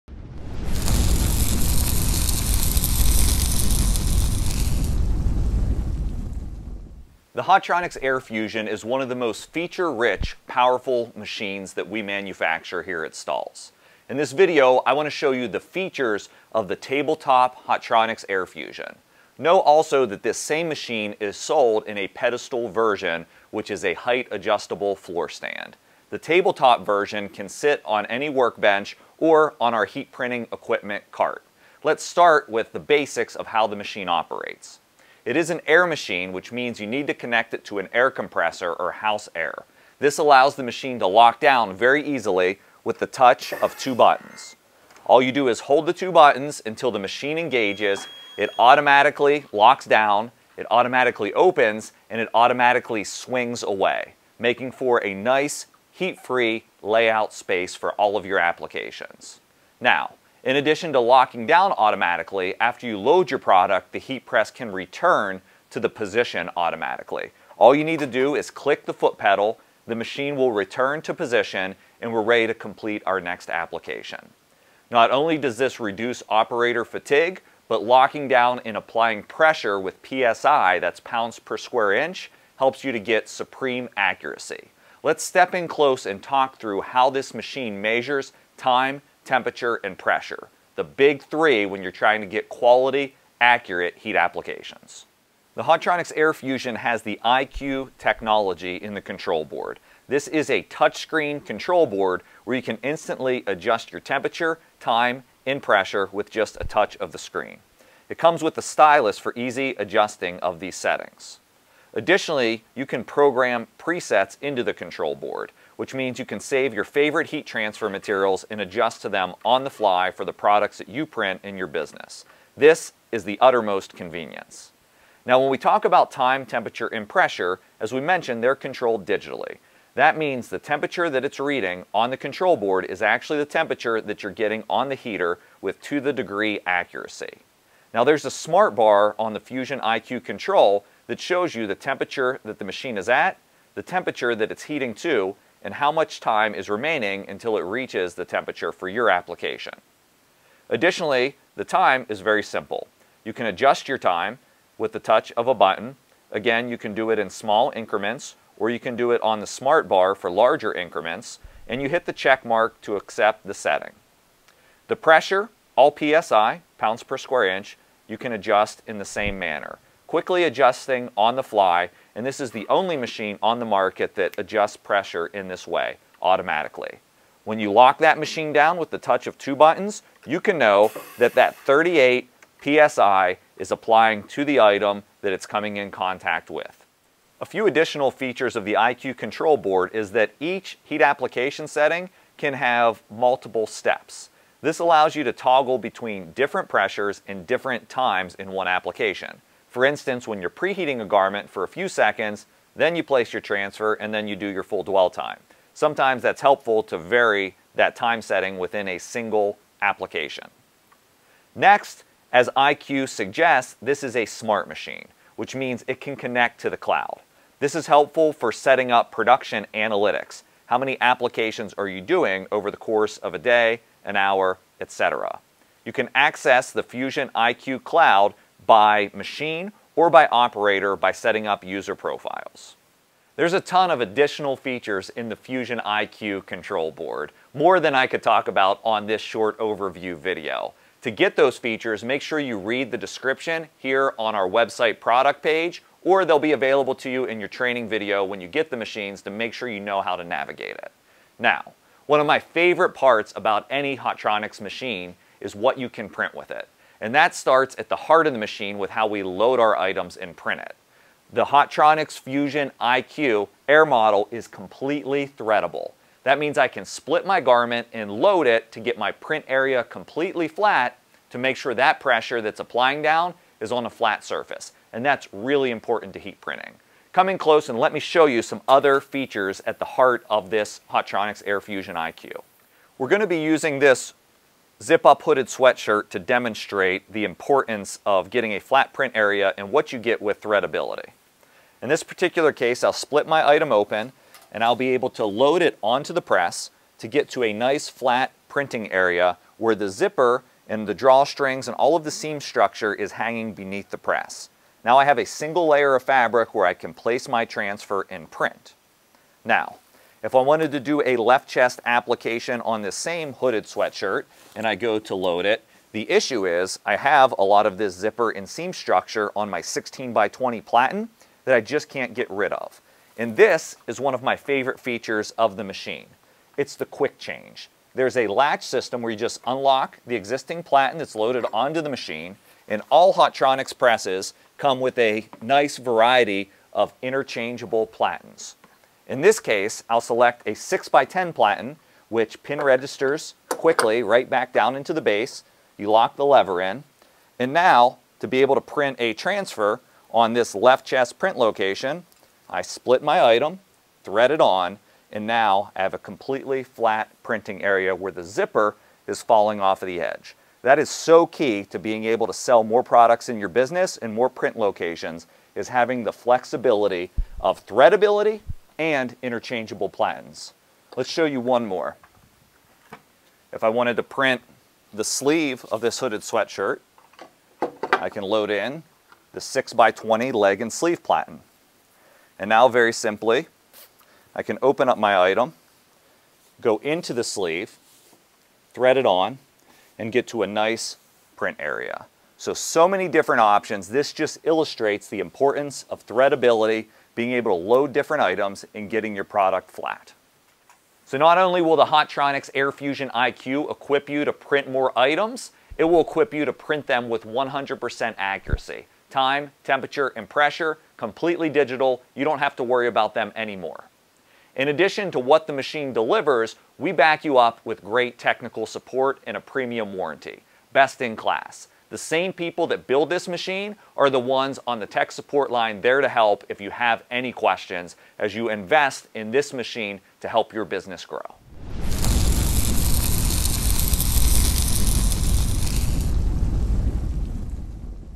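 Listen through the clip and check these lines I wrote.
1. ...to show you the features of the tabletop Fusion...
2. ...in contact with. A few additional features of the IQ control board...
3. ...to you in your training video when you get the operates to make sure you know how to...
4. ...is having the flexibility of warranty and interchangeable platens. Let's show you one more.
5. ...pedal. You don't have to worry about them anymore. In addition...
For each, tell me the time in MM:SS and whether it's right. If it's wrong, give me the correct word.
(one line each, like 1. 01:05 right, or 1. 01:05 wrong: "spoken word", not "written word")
1. 00:15 wrong: "Hotronix", not "Fusion"
2. 03:05 right
3. 04:06 wrong: "machines", not "operates"
4. 06:05 wrong: "threadability", not "warranty"
5. 06:51 wrong: "digital", not "pedal".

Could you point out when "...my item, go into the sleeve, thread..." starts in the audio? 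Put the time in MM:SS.
06:24.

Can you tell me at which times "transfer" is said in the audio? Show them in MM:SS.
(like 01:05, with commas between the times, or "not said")
01:57, 03:23, 05:07, 05:49.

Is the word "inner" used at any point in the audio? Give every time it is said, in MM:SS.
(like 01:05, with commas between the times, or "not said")
not said.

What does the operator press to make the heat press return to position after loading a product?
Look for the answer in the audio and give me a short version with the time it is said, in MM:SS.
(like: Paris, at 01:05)
Foot pedal, at 01:08.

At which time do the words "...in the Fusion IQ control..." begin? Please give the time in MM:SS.
03:55.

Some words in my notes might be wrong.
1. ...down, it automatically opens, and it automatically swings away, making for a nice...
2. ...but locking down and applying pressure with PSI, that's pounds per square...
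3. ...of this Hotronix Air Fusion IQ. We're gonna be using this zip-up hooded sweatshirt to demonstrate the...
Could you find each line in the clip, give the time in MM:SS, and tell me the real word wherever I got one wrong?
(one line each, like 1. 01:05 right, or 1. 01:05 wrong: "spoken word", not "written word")
1. 00:49 right
2. 01:17 right
3. 04:40 right.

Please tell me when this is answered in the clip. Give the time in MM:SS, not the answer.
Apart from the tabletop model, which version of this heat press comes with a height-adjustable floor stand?
00:22.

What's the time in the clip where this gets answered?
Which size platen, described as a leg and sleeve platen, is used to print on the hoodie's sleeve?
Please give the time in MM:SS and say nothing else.
06:19.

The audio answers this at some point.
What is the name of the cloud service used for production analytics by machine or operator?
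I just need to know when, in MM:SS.
03:46.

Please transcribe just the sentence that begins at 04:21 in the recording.
The Hotronix Fusion IQ Air model is completely threadable.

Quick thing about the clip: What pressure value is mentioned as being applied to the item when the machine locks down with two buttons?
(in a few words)
38 PSI.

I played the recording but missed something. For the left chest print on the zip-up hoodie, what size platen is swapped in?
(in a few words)
6x10.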